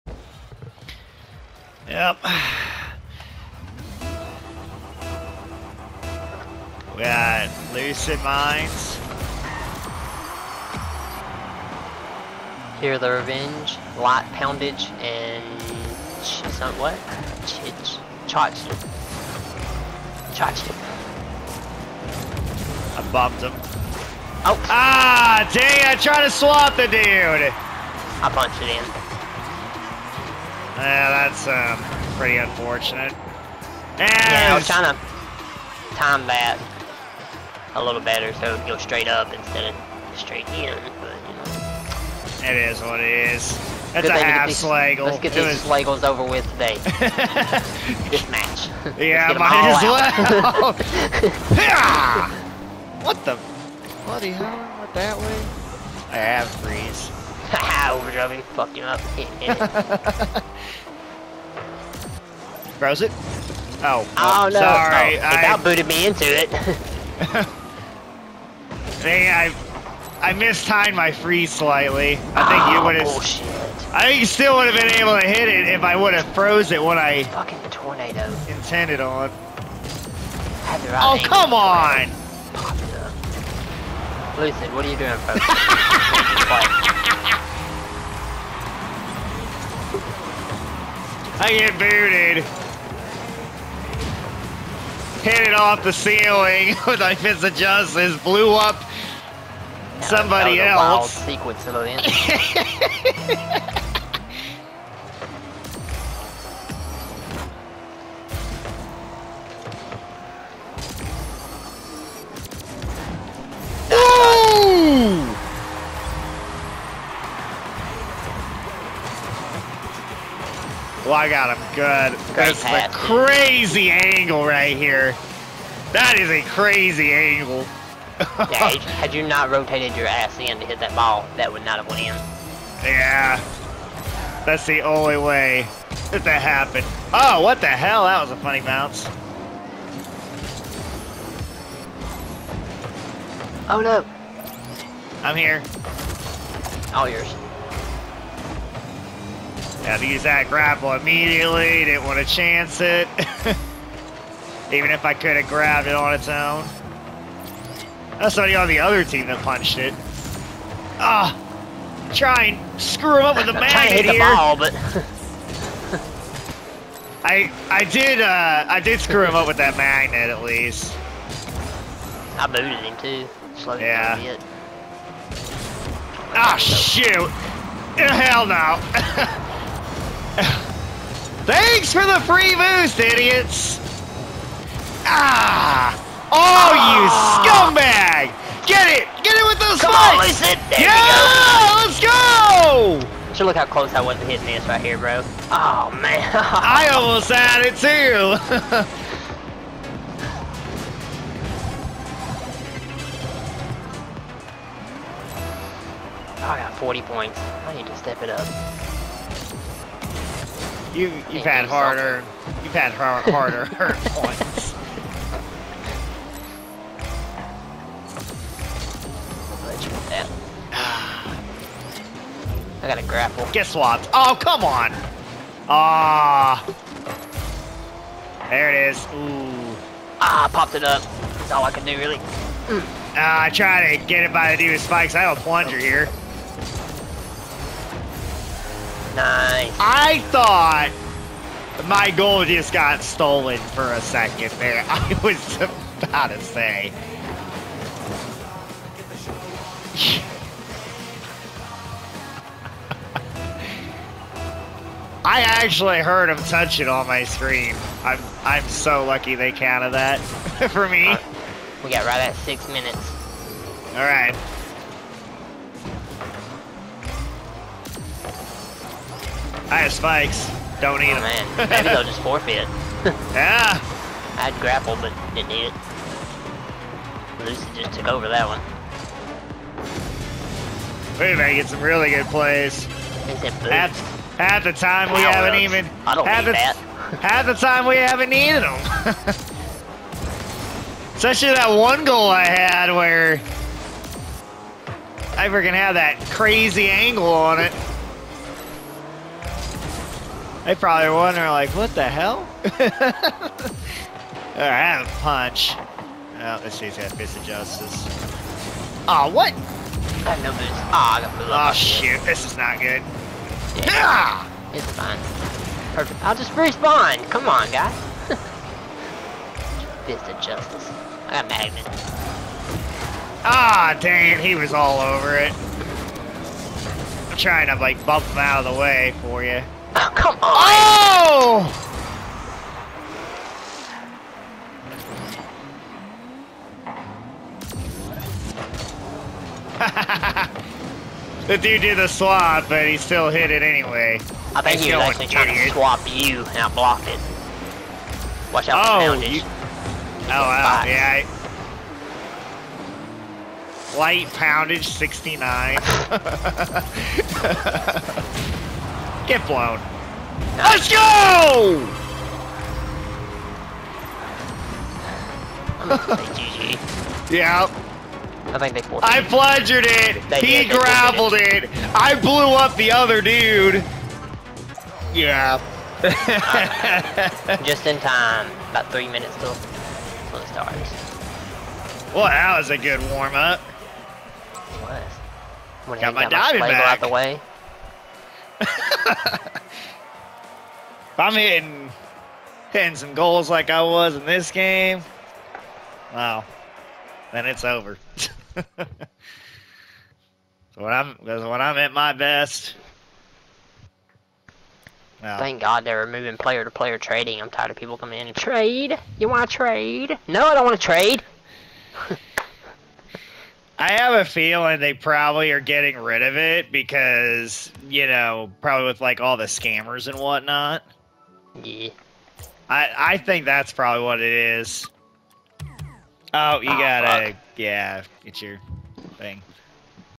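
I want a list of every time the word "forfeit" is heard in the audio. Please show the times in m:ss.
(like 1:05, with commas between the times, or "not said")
4:32.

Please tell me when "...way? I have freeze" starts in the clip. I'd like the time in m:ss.
0:55.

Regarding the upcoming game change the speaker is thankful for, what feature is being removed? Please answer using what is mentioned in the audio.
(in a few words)
Player to player trading.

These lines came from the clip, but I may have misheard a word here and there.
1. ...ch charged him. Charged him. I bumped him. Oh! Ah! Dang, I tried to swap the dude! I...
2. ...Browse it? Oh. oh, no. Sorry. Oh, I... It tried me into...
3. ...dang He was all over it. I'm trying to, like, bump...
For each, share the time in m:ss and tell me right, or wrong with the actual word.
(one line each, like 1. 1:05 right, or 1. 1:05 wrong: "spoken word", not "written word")
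1. 0:17 right
2. 1:02 wrong: "booted", not "tried"
3. 5:23 right.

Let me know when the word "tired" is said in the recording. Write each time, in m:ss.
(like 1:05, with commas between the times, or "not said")
6:47.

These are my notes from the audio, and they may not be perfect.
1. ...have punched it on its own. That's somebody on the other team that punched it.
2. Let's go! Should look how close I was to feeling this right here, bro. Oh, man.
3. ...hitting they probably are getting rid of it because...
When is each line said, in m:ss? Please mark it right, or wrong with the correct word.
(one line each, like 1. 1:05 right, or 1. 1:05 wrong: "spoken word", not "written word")
1. 2:35 wrong: "grabbed", not "punched"
2. 3:12 wrong: "hitting", not "feeling"
3. 6:54 wrong: "feeling", not "hitting".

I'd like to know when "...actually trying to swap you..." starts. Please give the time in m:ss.
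5:45.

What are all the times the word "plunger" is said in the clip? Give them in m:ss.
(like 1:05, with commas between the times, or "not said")
3:55, 6:09.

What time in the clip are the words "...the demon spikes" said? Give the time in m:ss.
3:54.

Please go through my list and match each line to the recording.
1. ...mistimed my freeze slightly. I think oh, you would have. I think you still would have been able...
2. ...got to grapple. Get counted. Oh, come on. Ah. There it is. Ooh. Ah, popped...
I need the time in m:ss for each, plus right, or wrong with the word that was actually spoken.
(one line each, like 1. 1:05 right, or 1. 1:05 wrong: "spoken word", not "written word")
1. 1:10 right
2. 3:42 wrong: "swapped", not "counted".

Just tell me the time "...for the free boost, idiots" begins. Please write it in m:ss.
3:01.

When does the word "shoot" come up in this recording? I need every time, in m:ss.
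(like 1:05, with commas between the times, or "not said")
2:56, 5:11.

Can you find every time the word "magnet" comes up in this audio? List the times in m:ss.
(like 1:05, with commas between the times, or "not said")
2:43, 2:49, 5:21.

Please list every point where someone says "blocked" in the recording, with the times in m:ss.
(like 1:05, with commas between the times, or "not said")
5:46.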